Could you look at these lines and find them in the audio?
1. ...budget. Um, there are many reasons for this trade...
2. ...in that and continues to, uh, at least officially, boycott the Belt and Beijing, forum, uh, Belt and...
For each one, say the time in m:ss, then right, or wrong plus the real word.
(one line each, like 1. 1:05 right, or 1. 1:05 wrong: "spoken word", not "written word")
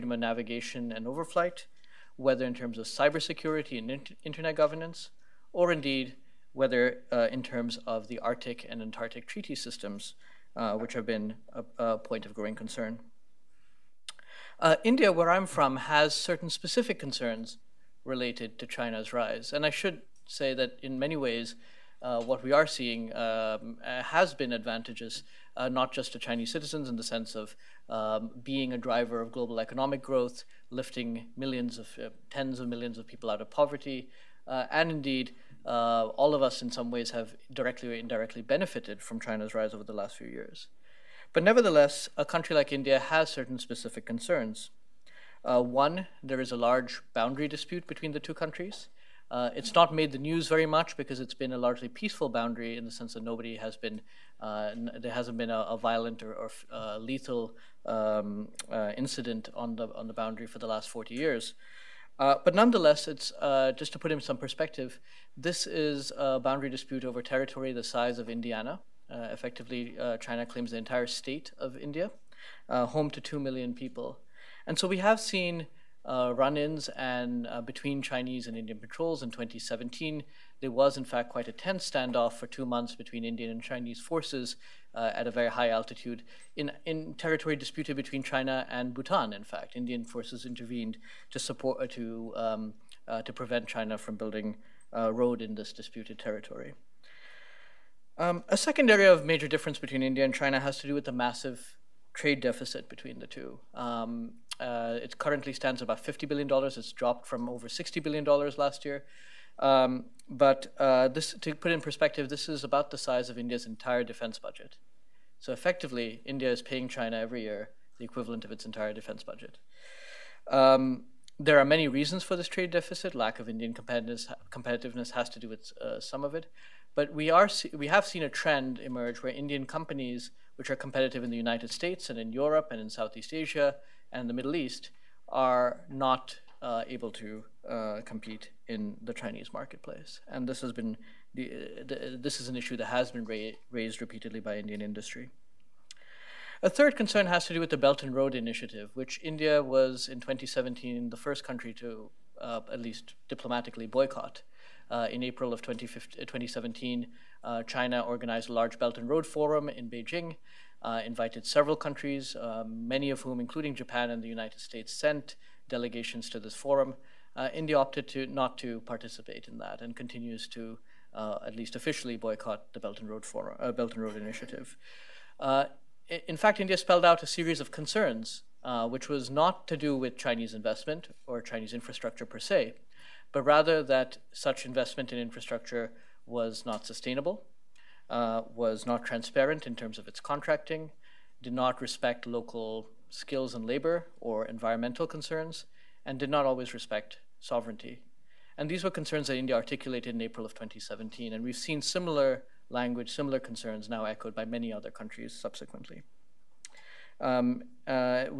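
1. 1:59 right
2. 2:49 wrong: "Road", not "Beijing".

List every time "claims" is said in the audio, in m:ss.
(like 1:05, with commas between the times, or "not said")
1:10.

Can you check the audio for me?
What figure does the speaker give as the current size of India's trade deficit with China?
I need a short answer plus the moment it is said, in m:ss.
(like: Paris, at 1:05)
$50 billion, at 1:46.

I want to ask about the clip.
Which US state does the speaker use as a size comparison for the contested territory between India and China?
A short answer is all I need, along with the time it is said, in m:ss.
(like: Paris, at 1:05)
Indiana, at 1:08.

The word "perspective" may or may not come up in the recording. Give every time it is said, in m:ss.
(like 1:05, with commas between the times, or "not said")
1:04, 1:51.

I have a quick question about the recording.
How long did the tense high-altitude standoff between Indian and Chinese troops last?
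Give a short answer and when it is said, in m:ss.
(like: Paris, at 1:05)
two months, at 1:22.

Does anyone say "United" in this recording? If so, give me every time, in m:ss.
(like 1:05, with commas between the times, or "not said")
2:11, 2:44.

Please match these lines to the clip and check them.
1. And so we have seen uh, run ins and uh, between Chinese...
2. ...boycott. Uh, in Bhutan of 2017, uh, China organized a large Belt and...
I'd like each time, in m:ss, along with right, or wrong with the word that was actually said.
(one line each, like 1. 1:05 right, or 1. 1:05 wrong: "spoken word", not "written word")
1. 1:14 right
2. 2:33 wrong: "April", not "Bhutan".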